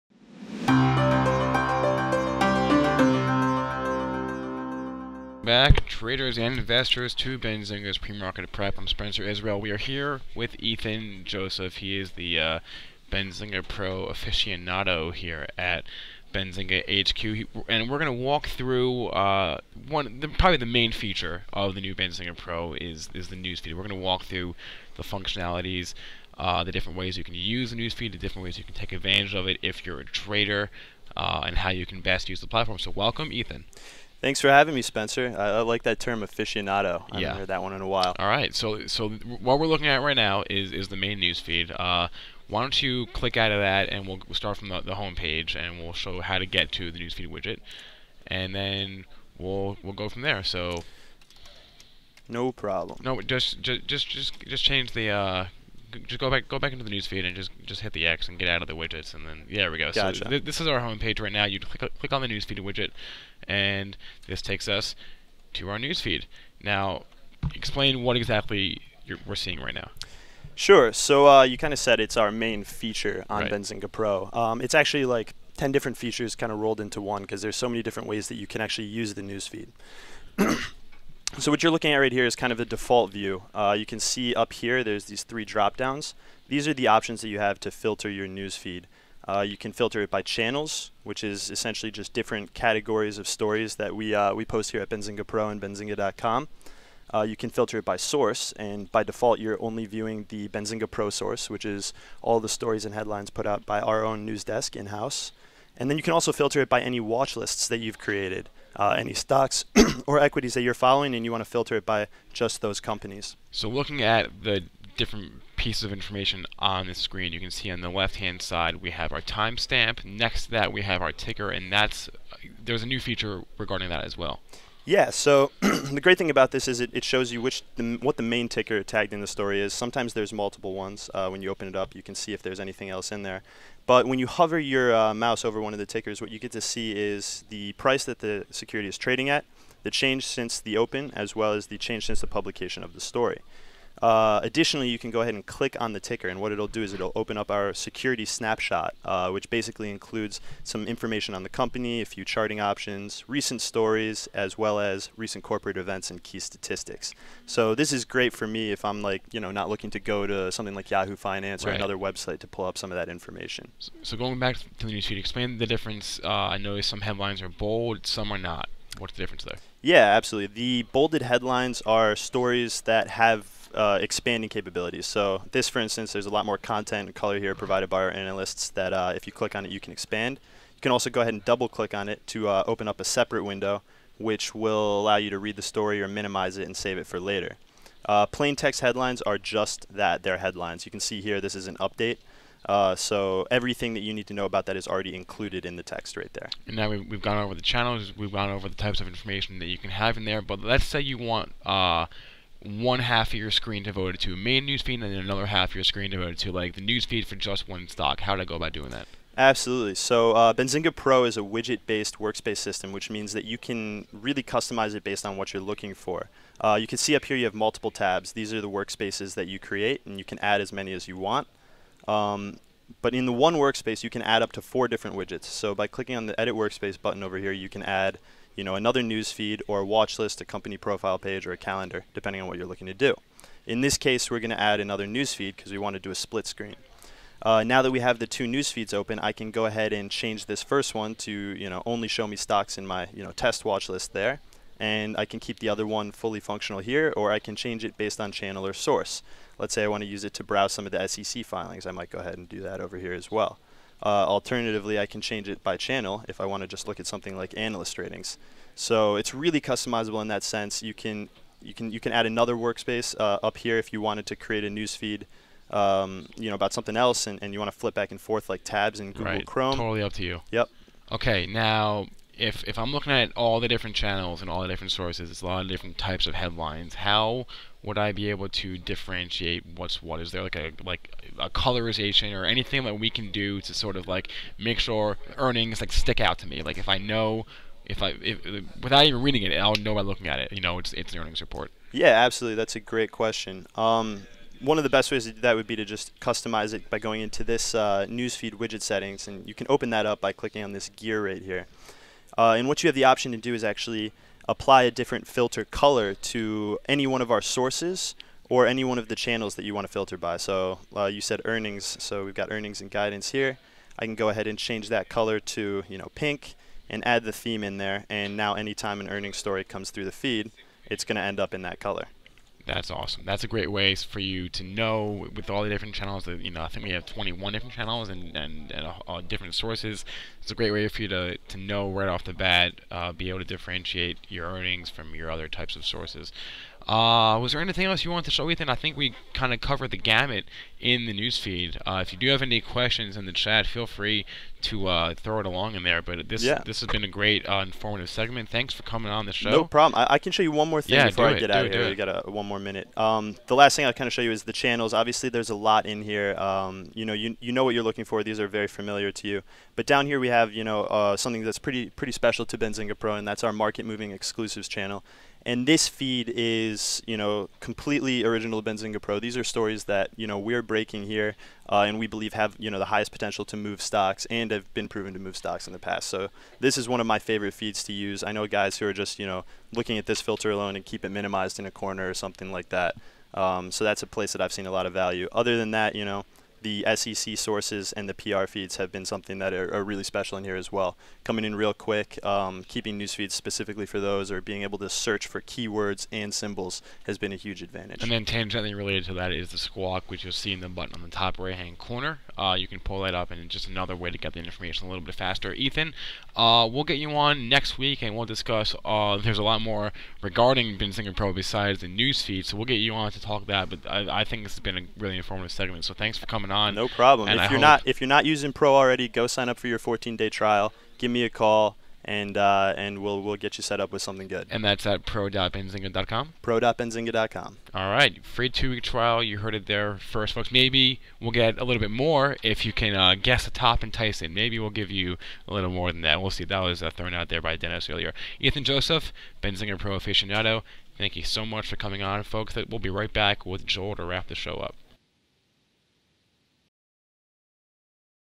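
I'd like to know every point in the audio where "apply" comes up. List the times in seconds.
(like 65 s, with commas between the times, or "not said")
304 s.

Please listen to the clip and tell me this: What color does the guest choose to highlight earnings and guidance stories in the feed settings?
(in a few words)
Pink.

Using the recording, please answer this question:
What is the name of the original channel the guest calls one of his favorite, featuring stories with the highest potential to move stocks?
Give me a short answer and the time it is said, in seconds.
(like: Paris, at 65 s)
Market moving exclusives, at 363 s.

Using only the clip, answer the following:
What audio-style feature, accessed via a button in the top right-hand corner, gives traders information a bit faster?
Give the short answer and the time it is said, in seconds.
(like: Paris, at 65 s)
The squawk, at 399 s.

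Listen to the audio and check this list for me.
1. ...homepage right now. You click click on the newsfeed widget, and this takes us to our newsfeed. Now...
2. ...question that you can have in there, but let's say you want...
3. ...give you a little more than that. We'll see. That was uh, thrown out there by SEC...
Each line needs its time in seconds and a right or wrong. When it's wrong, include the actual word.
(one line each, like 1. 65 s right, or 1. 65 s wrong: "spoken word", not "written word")
1. 60 s right
2. 199 s wrong: "information", not "question"
3. 434 s wrong: "Dennis", not "SEC".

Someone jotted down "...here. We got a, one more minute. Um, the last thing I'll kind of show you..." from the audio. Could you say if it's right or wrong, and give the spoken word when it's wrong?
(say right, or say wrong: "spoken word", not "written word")
right.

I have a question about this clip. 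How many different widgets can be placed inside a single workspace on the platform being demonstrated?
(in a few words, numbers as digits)
4.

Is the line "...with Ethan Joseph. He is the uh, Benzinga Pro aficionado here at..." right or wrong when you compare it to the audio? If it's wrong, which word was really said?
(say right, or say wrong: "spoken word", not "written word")
right.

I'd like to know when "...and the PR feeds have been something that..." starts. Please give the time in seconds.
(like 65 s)
387 s.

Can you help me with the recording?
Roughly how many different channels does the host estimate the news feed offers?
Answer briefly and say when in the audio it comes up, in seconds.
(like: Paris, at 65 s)
21, at 327 s.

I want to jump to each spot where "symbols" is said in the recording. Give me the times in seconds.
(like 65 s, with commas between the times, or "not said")
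396 s.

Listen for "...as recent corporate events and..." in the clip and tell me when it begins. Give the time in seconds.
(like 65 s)
154 s.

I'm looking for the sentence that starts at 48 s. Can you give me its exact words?
And then we'll we'll go from there.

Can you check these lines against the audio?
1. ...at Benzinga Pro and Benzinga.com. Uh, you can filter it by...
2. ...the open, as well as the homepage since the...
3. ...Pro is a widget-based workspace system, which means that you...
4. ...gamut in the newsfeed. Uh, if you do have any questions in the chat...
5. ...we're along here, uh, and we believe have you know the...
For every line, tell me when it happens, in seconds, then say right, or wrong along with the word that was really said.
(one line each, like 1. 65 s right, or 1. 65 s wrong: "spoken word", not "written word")
1. 94 s right
2. 140 s wrong: "change", not "homepage"
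3. 210 s right
4. 339 s right
5. 370 s wrong: "breaking", not "along".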